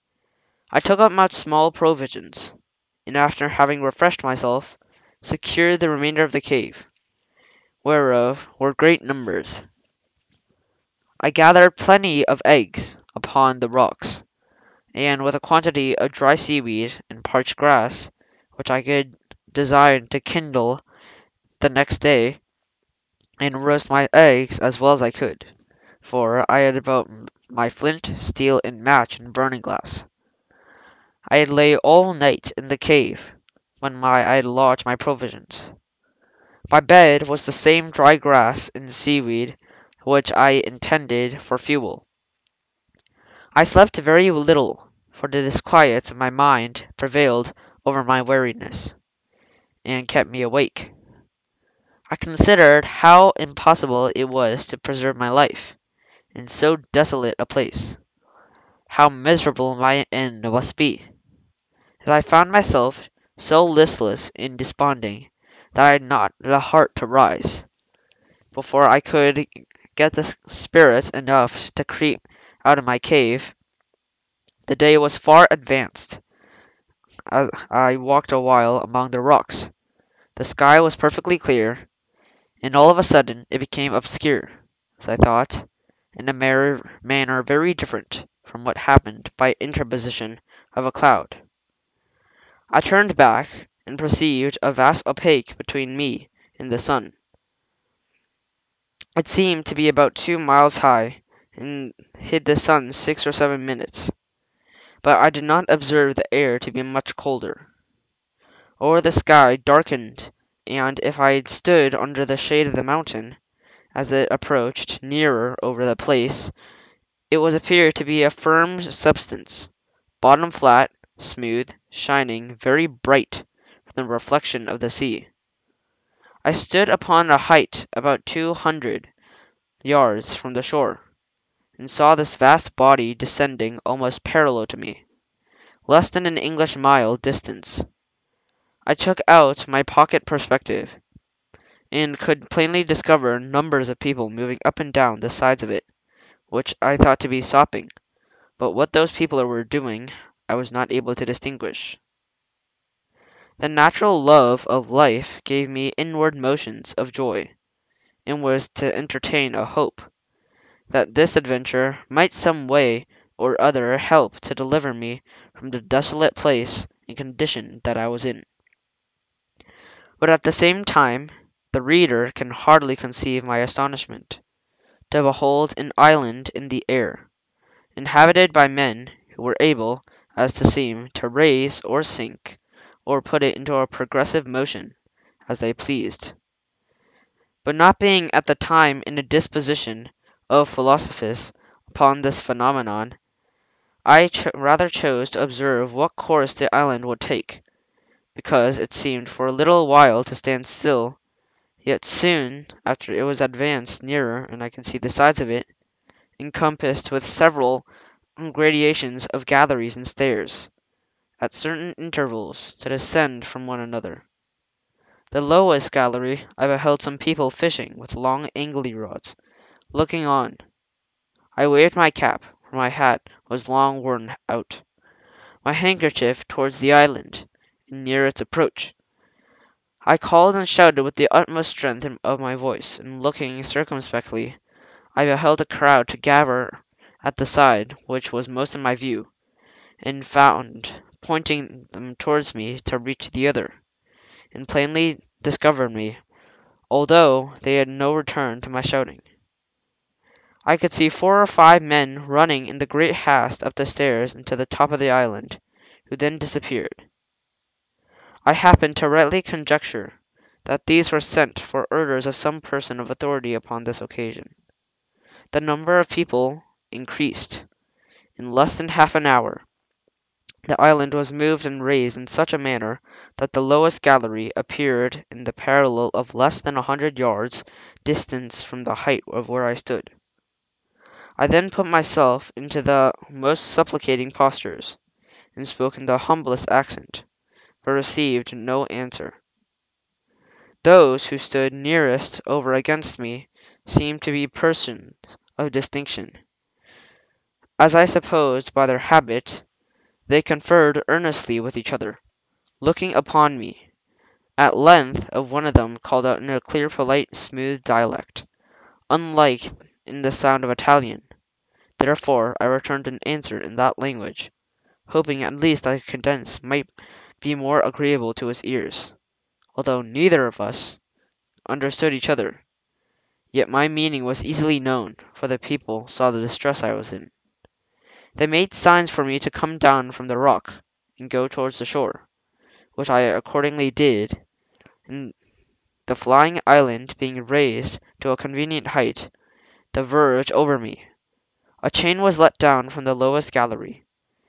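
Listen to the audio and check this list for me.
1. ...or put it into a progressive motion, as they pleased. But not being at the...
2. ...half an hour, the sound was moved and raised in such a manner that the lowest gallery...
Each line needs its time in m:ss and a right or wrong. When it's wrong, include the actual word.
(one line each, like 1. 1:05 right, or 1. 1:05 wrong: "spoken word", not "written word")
1. 3:03 right
2. 4:28 wrong: "island", not "sound".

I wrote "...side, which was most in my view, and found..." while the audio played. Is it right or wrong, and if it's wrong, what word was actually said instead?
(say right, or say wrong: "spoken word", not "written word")
right.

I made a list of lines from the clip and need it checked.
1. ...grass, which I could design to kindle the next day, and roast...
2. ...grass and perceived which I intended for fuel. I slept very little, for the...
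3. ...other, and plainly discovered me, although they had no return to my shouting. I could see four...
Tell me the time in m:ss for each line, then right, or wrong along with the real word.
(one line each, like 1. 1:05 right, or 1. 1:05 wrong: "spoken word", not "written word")
1. 0:17 right
2. 0:38 wrong: "seaweed", not "perceived"
3. 4:03 right.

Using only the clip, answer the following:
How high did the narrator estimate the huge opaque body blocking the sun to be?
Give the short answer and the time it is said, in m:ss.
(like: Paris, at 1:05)
2 miles, at 1:40.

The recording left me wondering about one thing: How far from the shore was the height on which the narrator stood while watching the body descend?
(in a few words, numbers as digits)
200 yards.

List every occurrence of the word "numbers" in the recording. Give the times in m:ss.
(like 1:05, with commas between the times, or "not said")
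0:09, 2:23, 4:25.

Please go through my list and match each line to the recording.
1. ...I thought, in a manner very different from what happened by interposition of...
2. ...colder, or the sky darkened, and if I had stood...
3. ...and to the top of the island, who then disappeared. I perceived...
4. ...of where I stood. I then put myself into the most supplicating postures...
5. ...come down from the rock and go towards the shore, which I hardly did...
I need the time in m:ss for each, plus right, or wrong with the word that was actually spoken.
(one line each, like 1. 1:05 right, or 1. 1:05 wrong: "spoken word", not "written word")
1. 1:25 right
2. 1:47 right
3. 4:14 wrong: "happened", not "perceived"
4. 4:39 right
5. 5:29 wrong: "accordingly", not "hardly".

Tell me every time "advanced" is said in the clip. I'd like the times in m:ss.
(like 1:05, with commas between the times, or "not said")
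1:15, 3:23.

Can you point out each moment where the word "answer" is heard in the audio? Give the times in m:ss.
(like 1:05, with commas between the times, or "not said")
4:48, 5:13.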